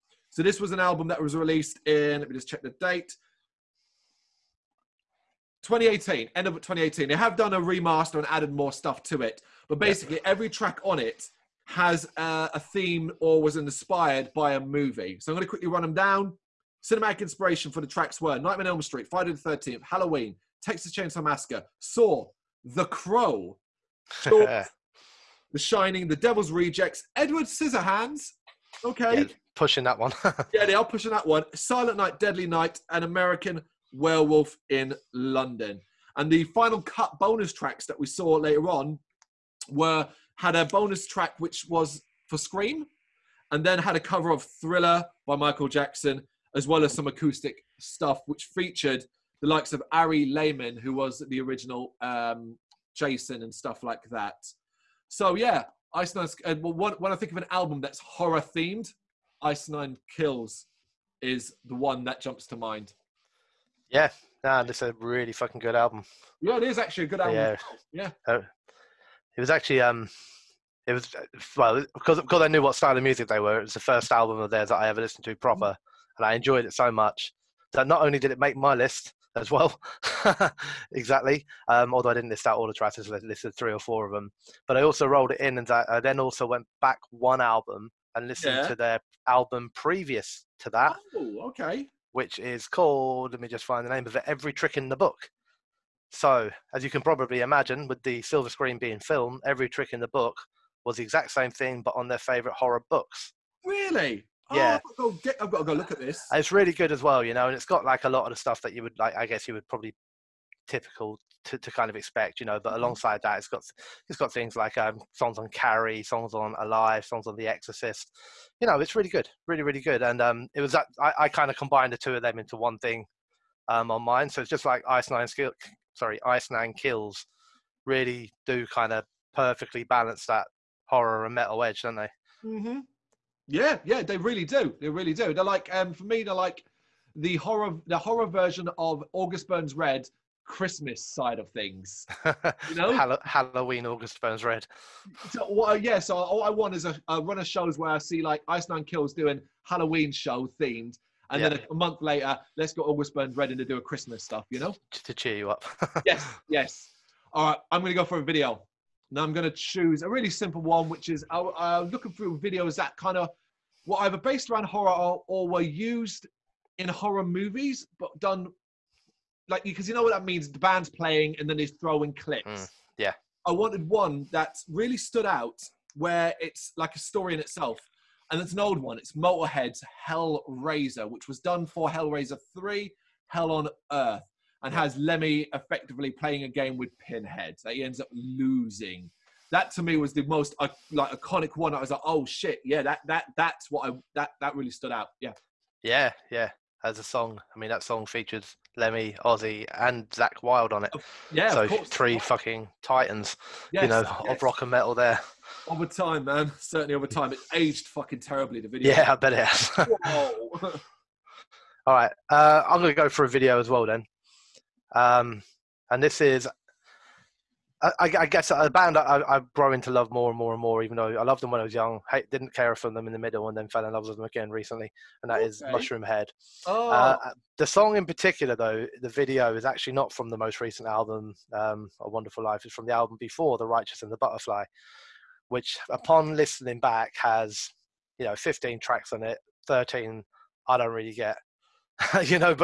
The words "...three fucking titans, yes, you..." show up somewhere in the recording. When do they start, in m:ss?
3:21.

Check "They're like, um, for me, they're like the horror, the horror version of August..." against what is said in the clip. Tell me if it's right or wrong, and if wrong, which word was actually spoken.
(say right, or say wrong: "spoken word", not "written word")
right.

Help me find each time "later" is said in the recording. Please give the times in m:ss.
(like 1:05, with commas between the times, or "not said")
0:38, 2:32.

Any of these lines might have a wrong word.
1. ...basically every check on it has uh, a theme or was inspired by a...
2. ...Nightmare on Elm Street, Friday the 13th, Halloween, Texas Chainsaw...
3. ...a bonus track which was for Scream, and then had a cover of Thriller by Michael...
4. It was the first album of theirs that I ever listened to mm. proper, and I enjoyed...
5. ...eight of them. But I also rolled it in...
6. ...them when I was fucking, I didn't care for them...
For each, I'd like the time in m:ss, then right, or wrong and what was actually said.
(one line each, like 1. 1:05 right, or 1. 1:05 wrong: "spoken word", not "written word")
1. 0:09 wrong: "track", not "check"
2. 0:18 right
3. 0:40 right
4. 1:13 right
5. 1:23 wrong: "four", not "eight"
6. 3:41 wrong: "young", not "fucking".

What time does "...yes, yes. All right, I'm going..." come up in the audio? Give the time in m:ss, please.
2:36.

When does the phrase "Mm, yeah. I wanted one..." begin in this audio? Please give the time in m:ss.
2:52.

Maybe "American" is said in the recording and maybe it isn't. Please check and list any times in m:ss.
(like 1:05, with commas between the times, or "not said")
0:33.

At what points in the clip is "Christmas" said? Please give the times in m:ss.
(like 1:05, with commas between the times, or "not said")
2:20, 2:33.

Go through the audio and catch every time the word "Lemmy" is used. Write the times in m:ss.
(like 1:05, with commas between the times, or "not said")
3:04, 3:18.